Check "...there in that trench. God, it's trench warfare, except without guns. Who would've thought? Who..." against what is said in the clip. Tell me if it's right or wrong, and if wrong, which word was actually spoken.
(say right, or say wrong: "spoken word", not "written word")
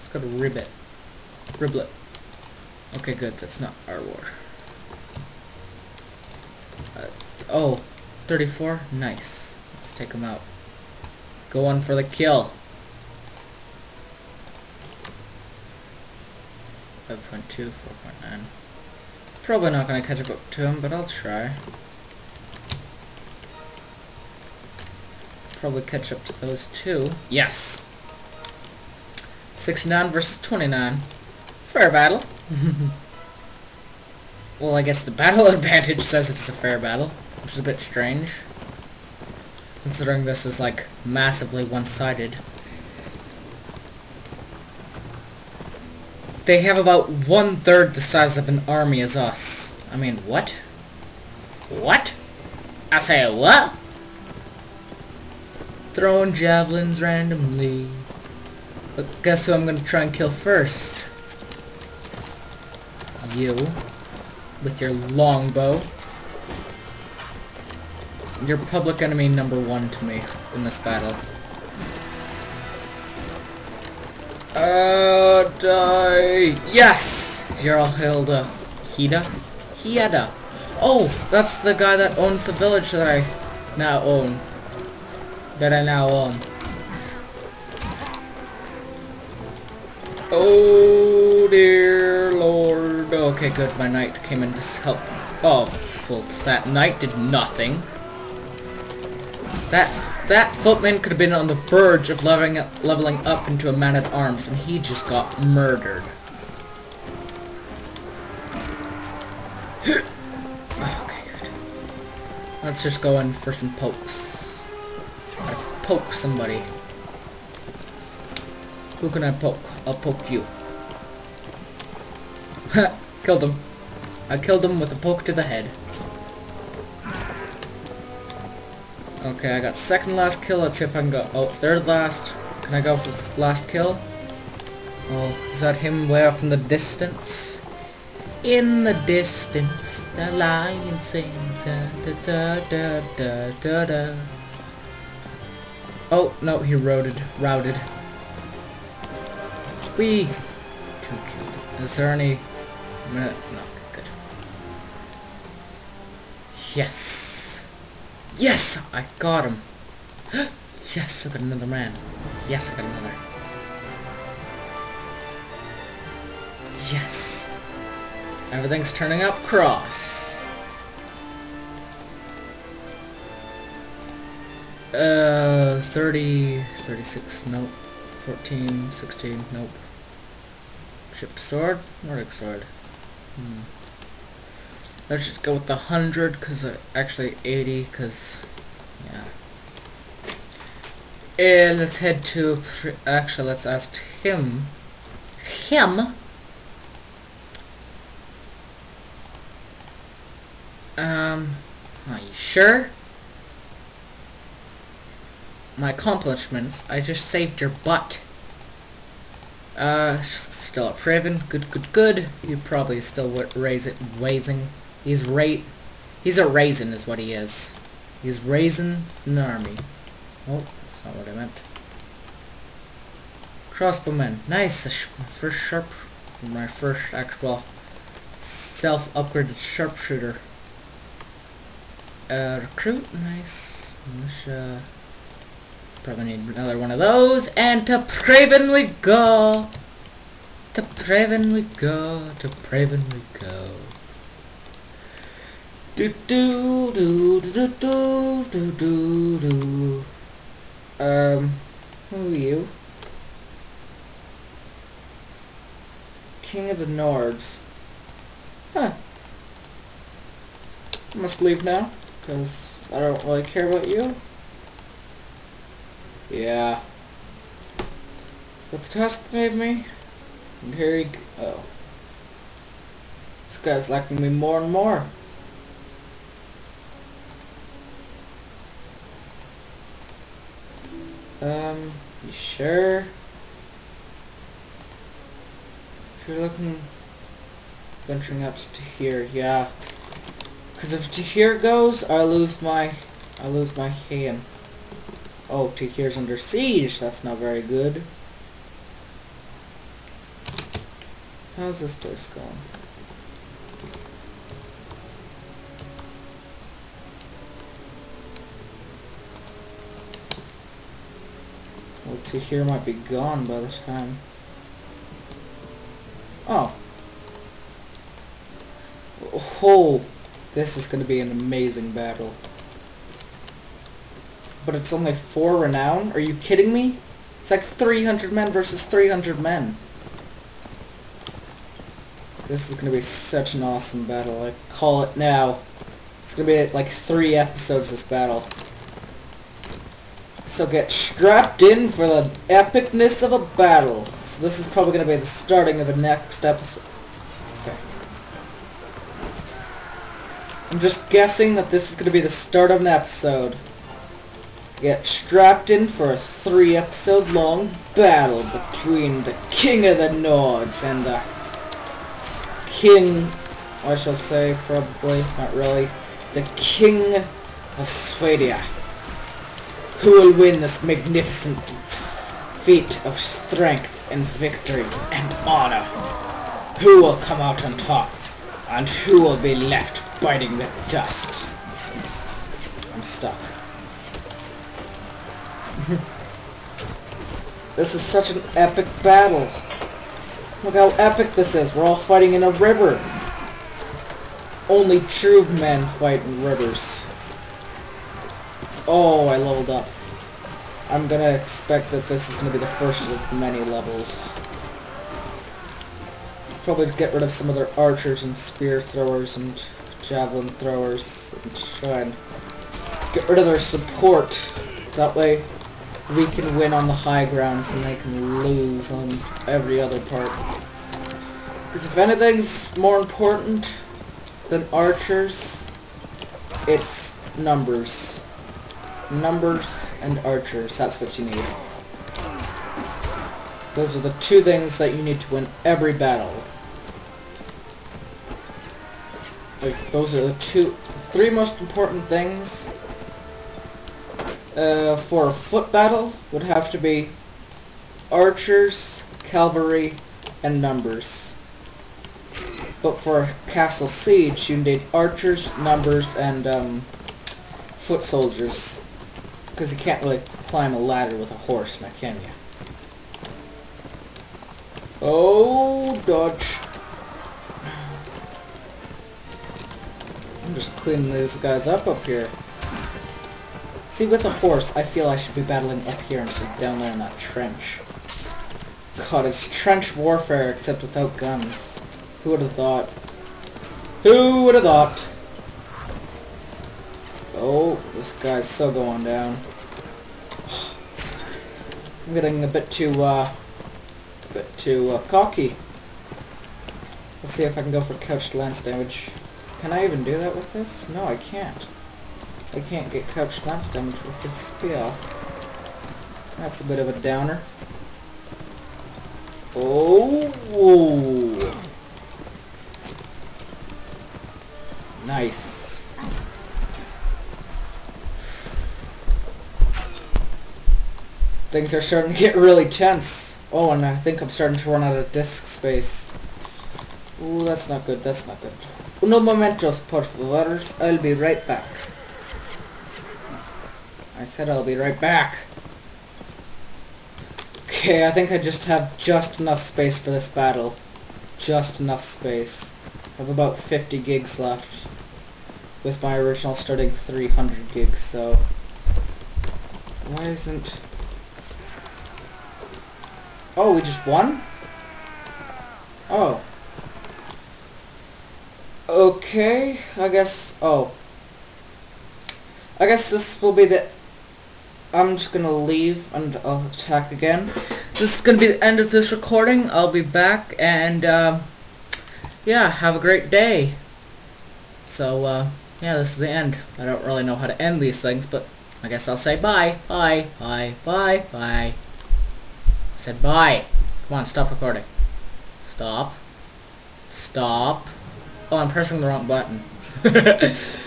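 right.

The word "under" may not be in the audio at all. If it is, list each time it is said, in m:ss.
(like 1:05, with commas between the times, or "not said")
4:56.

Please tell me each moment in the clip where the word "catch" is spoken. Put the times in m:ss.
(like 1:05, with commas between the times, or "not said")
0:20, 0:25.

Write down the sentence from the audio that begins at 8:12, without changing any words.
I'm getting a bit too, uh, a bit too uh, cocky.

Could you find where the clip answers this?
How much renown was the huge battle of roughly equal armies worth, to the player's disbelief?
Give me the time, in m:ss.
5:25.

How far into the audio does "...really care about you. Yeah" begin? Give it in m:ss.
4:23.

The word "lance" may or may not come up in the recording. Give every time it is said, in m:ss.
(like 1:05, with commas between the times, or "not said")
8:18, 8:23.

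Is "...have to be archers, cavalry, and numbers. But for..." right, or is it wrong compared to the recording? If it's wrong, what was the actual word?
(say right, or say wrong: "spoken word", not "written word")
right.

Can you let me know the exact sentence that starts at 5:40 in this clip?
So get strapped in for the epicness of a battle.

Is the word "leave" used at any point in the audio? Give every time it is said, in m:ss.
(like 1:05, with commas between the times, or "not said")
4:21, 9:25.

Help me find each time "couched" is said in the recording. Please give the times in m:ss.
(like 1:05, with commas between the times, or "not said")
8:17, 8:23.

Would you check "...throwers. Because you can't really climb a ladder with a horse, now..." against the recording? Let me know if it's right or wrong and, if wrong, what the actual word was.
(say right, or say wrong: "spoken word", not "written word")
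wrong: "soldiers", not "throwers".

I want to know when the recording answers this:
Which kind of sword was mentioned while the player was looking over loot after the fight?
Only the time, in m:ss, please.
3:02.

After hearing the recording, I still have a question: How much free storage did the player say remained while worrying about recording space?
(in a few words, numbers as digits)
50 gigs.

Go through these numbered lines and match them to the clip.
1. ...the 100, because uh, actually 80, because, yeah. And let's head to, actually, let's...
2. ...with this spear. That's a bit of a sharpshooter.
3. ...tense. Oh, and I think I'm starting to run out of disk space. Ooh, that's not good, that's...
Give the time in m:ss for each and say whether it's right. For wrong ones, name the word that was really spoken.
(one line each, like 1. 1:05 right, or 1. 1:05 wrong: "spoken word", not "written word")
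1. 3:05 right
2. 8:24 wrong: "downer", not "sharpshooter"
3. 8:42 right.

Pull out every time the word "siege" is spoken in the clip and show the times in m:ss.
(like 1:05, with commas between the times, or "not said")
4:56, 7:33.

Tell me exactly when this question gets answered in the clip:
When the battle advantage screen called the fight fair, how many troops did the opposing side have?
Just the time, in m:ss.
0:30.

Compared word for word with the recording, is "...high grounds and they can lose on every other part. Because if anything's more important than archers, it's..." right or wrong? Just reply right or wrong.
right.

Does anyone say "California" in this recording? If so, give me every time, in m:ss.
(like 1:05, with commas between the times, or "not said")
not said.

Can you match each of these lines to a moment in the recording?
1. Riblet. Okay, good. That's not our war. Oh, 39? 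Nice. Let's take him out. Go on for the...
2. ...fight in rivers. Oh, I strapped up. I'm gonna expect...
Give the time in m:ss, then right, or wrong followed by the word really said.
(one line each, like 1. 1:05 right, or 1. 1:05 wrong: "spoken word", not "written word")
1. 0:01 wrong: "34", not "39"
2. 6:35 wrong: "leveled", not "strapped".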